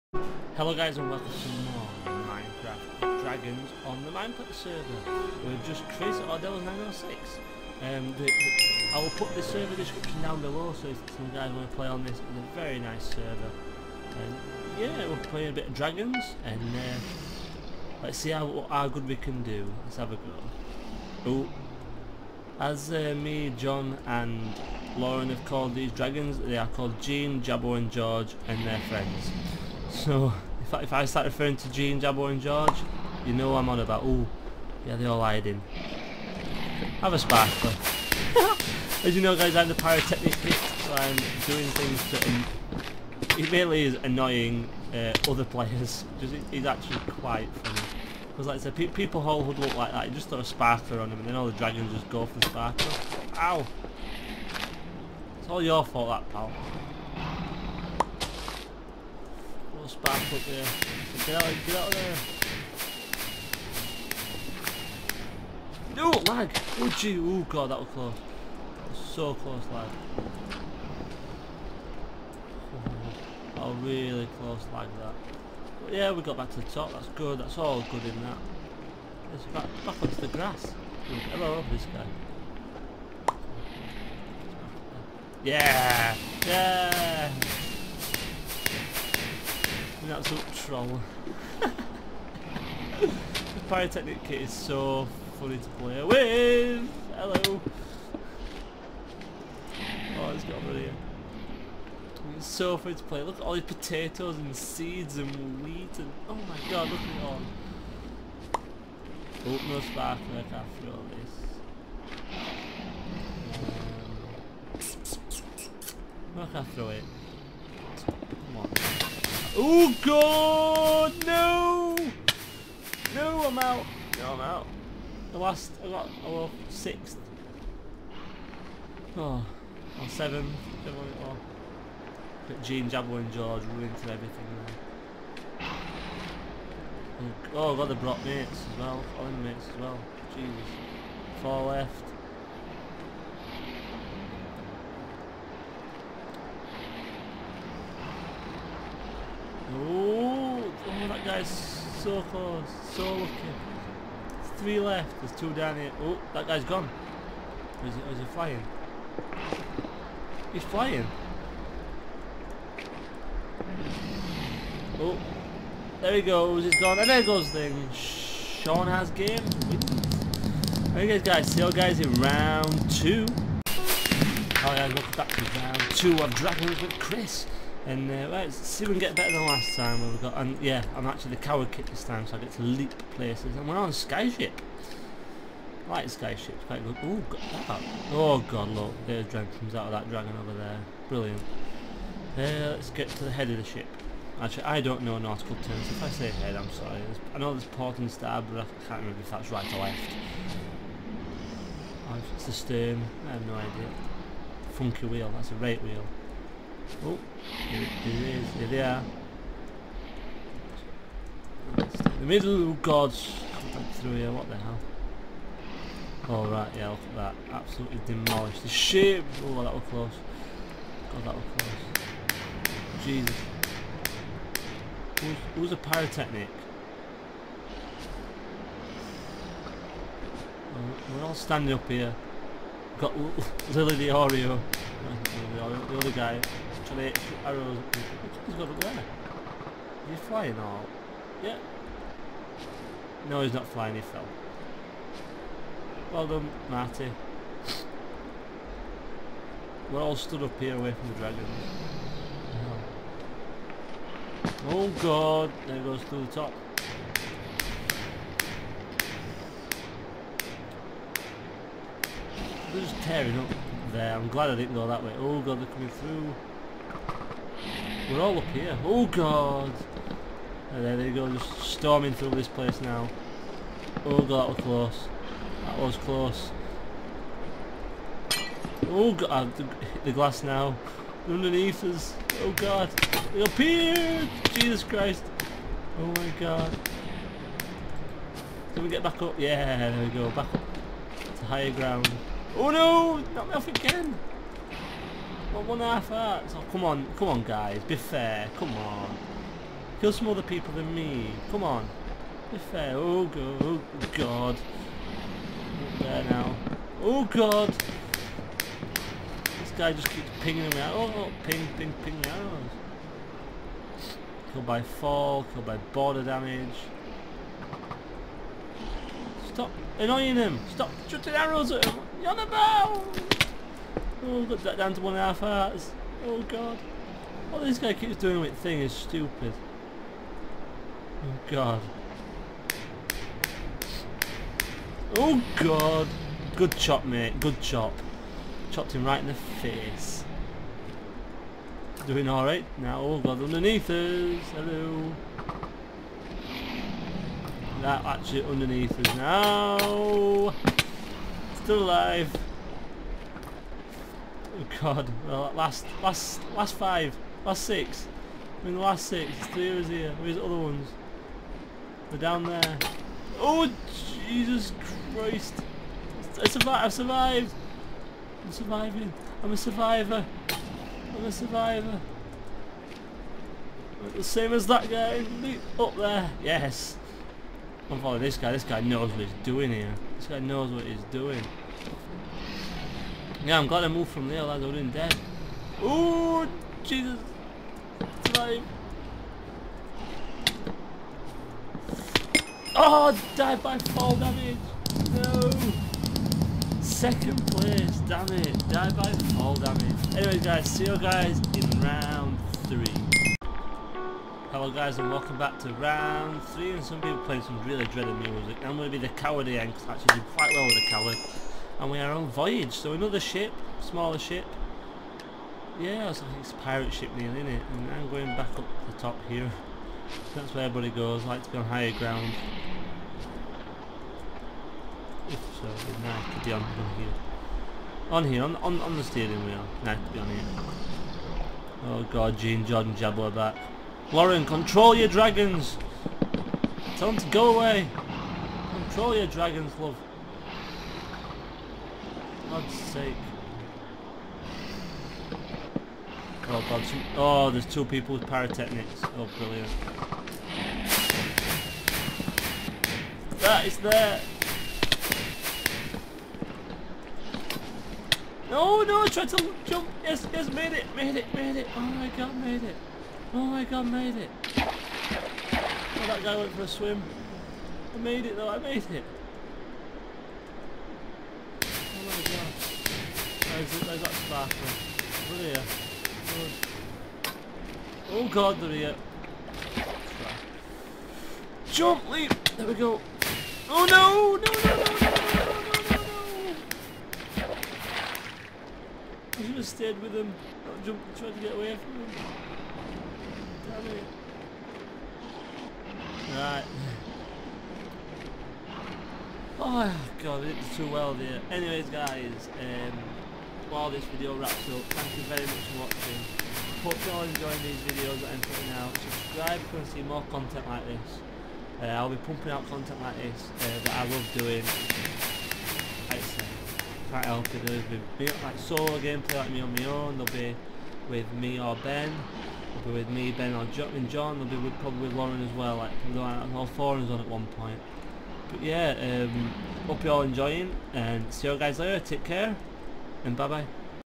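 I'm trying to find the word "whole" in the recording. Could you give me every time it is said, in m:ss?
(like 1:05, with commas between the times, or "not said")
0:49.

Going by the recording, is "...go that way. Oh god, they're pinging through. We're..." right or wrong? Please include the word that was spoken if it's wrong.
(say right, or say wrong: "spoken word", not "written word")
wrong: "coming", not "pinging".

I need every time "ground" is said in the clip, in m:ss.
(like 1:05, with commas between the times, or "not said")
4:51, 7:01.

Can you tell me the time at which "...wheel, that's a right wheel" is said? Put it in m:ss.
3:25.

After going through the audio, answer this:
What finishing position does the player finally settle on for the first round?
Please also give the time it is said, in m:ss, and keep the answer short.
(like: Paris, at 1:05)
7th, at 2:10.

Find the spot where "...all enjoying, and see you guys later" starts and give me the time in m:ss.
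8:50.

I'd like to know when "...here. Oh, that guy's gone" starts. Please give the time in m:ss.
2:35.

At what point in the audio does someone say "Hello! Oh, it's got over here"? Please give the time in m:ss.
1:37.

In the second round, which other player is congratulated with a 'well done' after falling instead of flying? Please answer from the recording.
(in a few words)
Marty.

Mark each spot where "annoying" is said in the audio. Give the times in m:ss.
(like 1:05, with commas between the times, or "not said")
0:44, 5:19.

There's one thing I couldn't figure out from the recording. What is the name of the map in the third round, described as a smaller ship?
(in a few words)
Voyage.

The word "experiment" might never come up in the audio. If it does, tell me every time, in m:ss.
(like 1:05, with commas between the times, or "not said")
not said.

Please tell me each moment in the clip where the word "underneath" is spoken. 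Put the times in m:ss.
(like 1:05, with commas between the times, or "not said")
4:41, 5:43, 5:48.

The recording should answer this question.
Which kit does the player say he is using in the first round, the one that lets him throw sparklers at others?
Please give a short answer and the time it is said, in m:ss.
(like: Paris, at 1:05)
Pyrotechnic kit, at 1:33.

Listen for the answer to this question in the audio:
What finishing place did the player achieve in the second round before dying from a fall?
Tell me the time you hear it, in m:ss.
6:36.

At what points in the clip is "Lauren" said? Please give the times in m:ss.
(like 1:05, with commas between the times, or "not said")
0:24, 7:14, 8:45.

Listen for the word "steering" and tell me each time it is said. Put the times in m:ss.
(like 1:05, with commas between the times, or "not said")
7:09.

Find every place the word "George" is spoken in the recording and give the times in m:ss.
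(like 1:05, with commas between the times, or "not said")
0:27, 0:32, 2:13.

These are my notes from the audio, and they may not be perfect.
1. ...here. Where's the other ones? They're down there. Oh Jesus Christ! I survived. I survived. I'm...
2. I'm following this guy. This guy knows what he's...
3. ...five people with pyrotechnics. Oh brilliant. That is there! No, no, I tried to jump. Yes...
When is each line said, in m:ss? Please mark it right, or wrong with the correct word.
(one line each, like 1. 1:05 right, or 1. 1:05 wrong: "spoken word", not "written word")
1. 5:59 right
2. 6:17 right
3. 7:27 wrong: "two", not "five".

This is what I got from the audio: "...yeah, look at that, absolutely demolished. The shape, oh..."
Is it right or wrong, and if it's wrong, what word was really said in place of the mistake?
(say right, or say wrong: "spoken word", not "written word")
right.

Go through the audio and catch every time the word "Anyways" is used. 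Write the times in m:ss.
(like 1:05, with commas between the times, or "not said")
6:40, 8:21.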